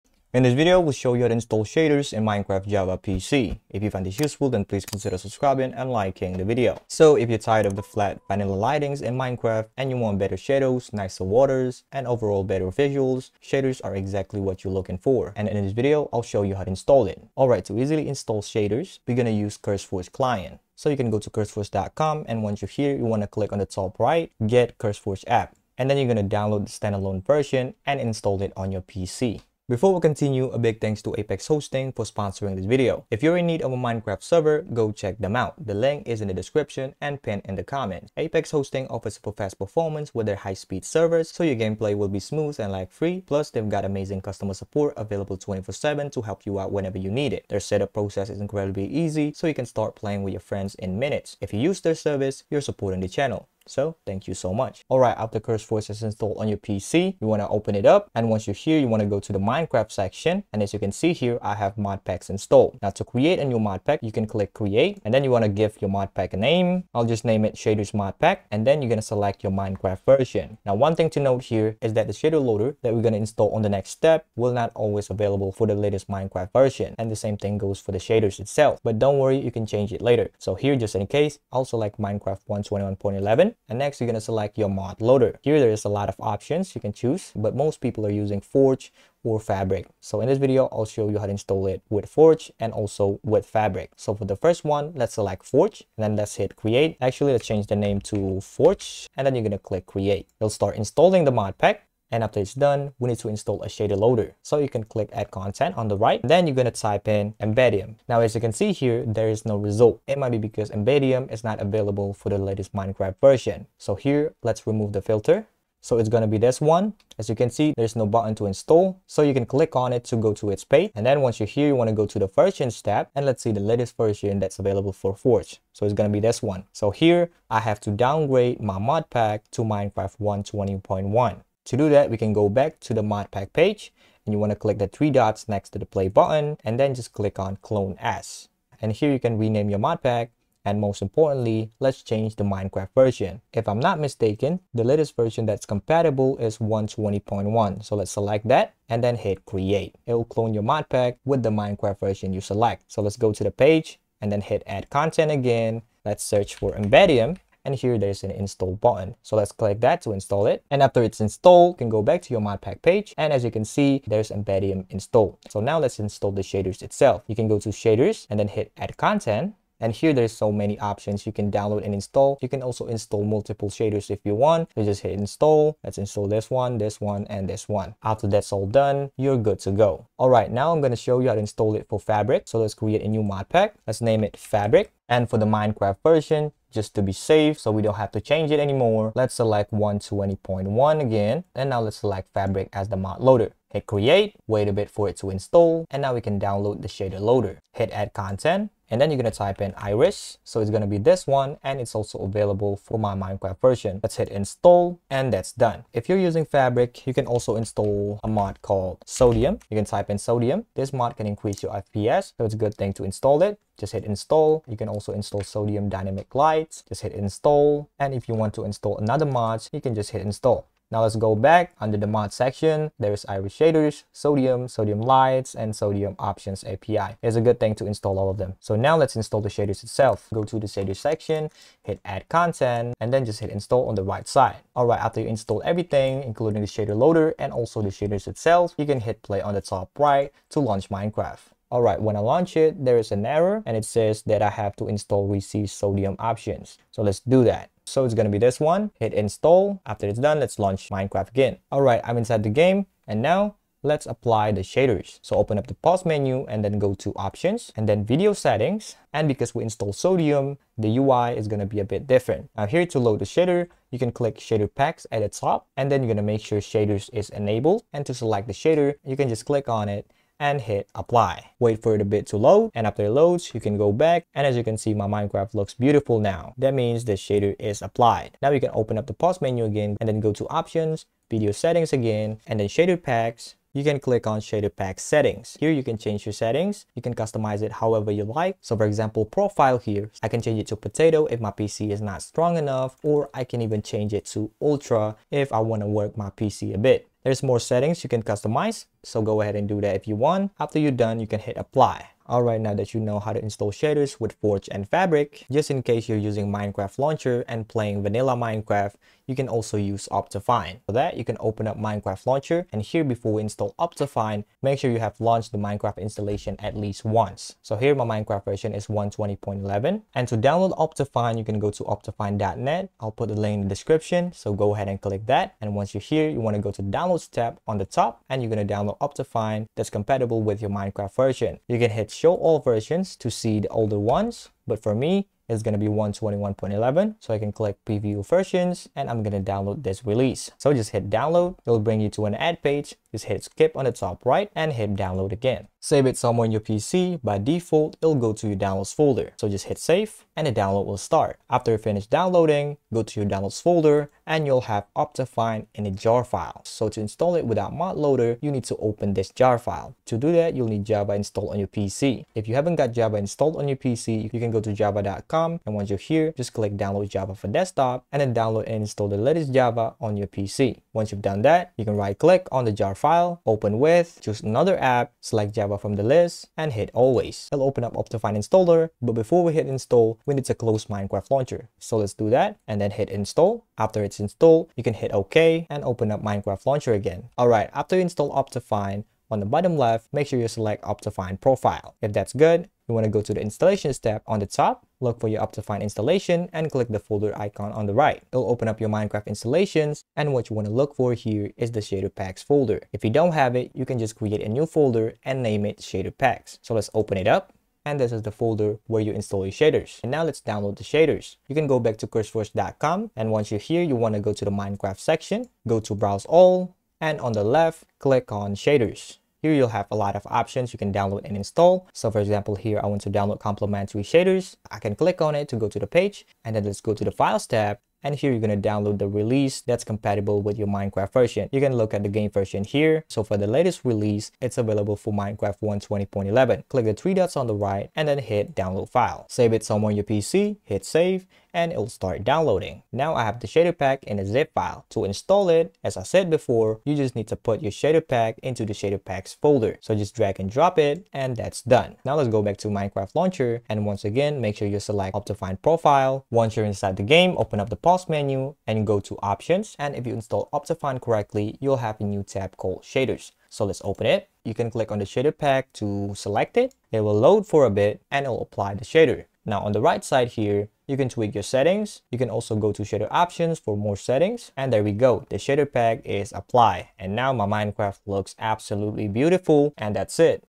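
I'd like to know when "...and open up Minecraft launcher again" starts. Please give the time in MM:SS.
06:25.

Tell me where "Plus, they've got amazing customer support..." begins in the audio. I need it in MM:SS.
00:43.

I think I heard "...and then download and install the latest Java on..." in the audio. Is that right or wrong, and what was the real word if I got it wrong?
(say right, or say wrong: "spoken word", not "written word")
right.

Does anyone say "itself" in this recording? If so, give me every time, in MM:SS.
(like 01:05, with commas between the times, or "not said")
01:18, 02:46, 03:49, 03:58.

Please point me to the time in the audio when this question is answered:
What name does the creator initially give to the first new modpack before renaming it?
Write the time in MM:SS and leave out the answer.
01:07.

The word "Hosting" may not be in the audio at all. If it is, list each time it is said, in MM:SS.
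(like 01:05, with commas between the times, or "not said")
00:31, 00:38.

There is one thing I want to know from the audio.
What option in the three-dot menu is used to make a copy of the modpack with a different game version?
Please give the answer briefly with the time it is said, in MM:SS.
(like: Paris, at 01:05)
clone as, at 02:17.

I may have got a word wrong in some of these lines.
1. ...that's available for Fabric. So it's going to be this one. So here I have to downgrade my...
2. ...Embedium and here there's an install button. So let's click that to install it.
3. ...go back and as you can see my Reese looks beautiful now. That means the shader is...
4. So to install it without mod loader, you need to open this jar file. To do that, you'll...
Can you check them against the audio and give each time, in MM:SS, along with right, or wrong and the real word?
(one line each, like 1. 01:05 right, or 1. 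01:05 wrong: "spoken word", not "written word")
1. 02:04 wrong: "Forge", not "Fabric"
2. 02:36 right
3. 04:33 wrong: "Minecraft", not "Reese"
4. 05:56 right.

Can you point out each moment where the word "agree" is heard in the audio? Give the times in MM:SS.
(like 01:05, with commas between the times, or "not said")
not said.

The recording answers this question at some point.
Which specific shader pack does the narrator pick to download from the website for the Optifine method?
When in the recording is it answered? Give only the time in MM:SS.
07:03.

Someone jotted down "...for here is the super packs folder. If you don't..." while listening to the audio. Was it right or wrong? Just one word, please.
wrong.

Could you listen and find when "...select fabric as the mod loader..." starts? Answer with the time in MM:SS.
03:11.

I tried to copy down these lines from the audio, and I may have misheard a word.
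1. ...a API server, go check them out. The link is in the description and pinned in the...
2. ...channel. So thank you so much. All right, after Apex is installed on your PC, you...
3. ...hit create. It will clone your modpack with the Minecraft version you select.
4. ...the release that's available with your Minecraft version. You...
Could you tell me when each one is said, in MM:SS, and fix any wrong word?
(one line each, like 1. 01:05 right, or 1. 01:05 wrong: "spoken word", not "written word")
1. 00:33 wrong: "Minecraft", not "API"
2. 00:53 wrong: "CurseForge", not "Apex"
3. 02:29 right
4. 07:08 wrong: "compatible", not "available".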